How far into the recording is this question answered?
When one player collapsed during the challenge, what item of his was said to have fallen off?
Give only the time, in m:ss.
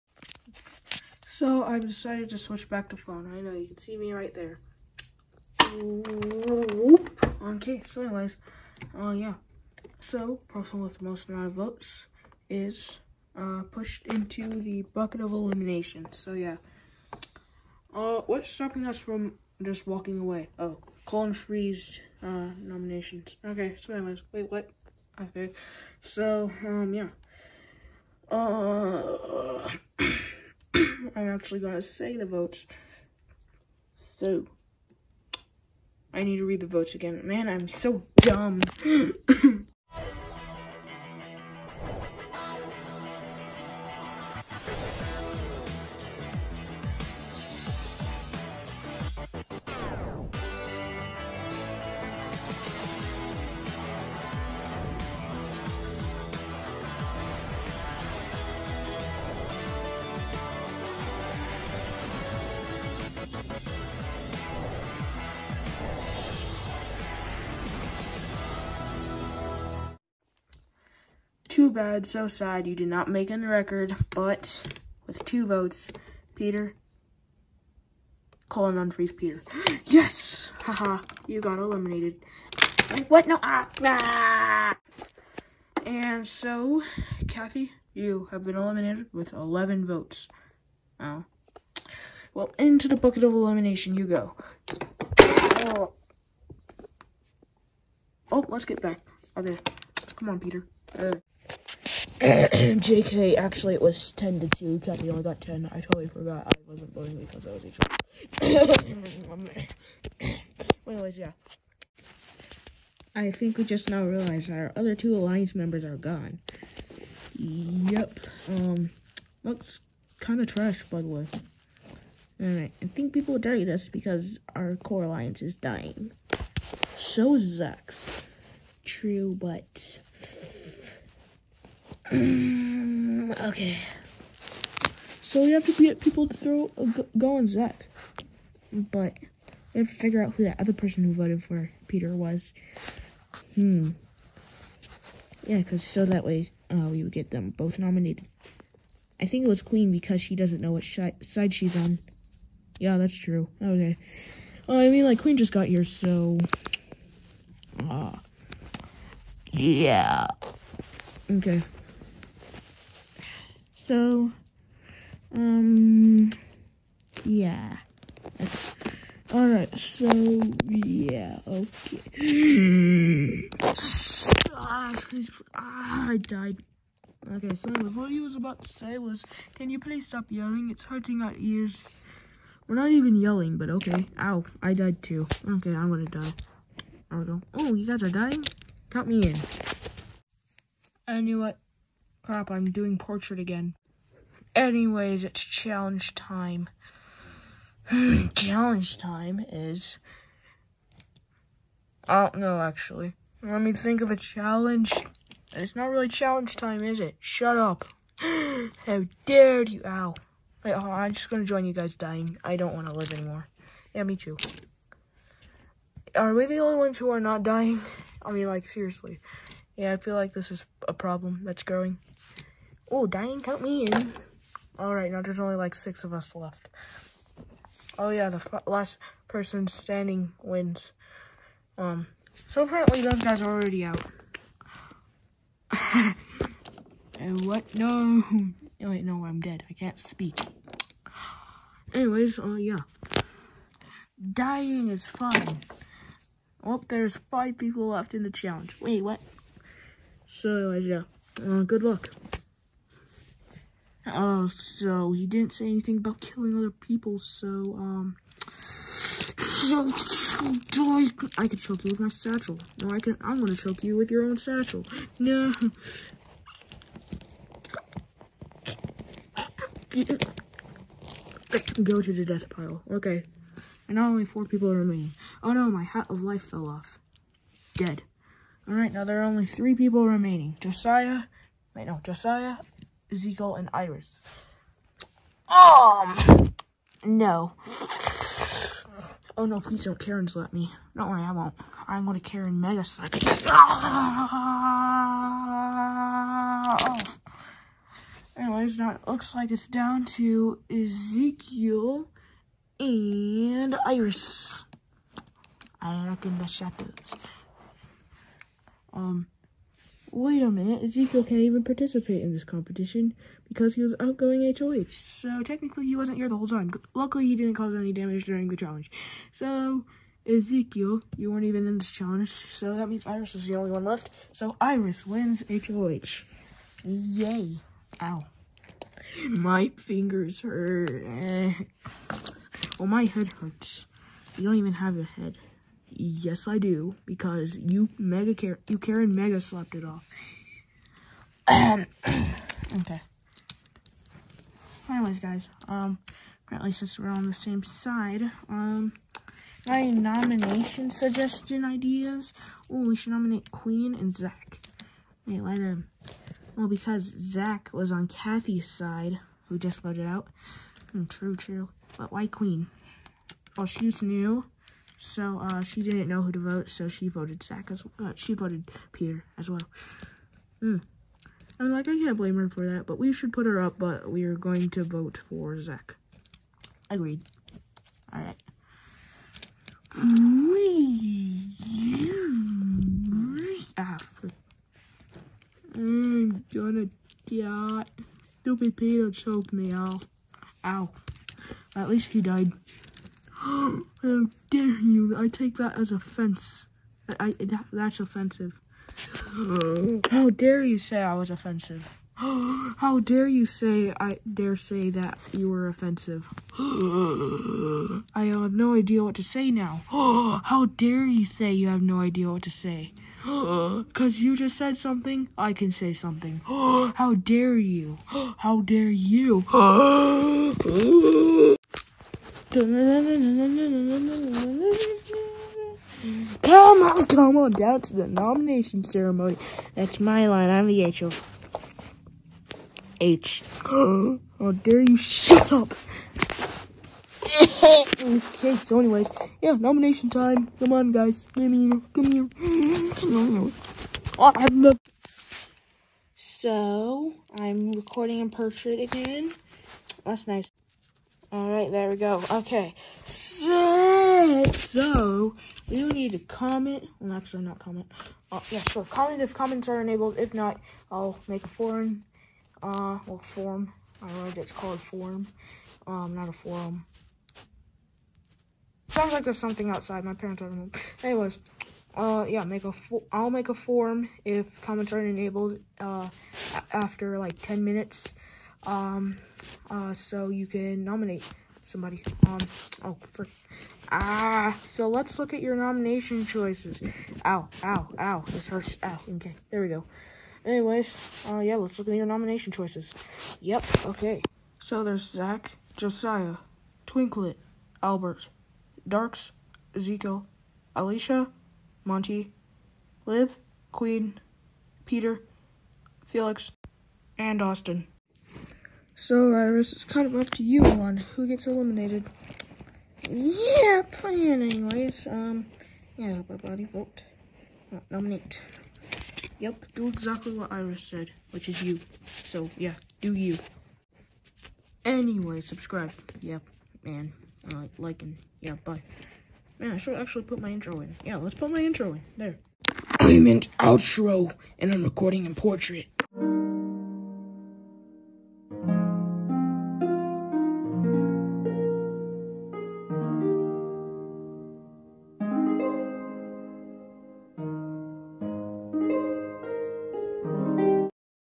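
4:35.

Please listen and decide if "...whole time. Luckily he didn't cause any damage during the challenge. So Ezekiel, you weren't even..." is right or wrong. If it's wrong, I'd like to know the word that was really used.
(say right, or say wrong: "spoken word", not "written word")
right.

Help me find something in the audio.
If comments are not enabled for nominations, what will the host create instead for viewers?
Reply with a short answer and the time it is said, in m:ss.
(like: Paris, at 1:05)
a form, at 7:53.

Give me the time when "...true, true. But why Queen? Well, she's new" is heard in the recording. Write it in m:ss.
6:01.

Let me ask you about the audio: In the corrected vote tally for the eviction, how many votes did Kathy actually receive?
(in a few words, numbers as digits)
10.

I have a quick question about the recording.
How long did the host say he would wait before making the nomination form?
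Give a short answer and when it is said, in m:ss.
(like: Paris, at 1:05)
10 minutes, at 7:56.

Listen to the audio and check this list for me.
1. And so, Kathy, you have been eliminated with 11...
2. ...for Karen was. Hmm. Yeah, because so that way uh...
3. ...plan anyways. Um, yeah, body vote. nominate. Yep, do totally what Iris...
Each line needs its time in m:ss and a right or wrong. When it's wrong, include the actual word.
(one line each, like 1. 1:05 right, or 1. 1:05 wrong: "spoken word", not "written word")
1. 1:25 right
2. 2:21 wrong: "Peter", not "Karen"
3. 8:33 wrong: "exactly", not "totally".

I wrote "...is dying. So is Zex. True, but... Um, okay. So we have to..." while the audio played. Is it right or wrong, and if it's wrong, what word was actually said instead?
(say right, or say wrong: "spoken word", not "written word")
right.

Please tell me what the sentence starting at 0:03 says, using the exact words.
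I know you can see me right there.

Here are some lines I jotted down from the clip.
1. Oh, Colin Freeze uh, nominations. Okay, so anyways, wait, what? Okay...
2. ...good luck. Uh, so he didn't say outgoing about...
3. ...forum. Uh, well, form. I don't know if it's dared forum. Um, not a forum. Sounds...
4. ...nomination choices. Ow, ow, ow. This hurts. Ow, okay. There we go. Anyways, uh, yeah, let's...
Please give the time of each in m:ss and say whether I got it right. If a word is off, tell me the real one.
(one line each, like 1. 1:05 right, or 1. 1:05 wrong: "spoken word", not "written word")
1. 0:20 right
2. 4:11 wrong: "anything", not "outgoing"
3. 7:41 wrong: "called", not "dared"
4. 8:05 right.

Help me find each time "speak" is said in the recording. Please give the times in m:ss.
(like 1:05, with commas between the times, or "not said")
3:59.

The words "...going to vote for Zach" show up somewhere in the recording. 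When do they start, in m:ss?
6:14.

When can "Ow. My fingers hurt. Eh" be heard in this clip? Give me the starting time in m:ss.
5:28.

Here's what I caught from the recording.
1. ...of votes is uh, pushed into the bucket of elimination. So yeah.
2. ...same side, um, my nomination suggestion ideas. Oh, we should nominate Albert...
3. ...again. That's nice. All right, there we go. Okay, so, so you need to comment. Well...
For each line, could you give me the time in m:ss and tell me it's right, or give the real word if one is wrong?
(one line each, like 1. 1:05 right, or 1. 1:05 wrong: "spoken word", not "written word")
1. 0:11 right
2. 5:47 wrong: "Queen", not "Albert"
3. 7:28 right.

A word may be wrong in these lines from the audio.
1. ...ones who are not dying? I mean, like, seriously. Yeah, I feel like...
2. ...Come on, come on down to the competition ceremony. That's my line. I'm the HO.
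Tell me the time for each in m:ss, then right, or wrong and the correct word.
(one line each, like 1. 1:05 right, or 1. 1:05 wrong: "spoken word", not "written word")
1. 3:36 right
2. 7:02 wrong: "nomination", not "competition".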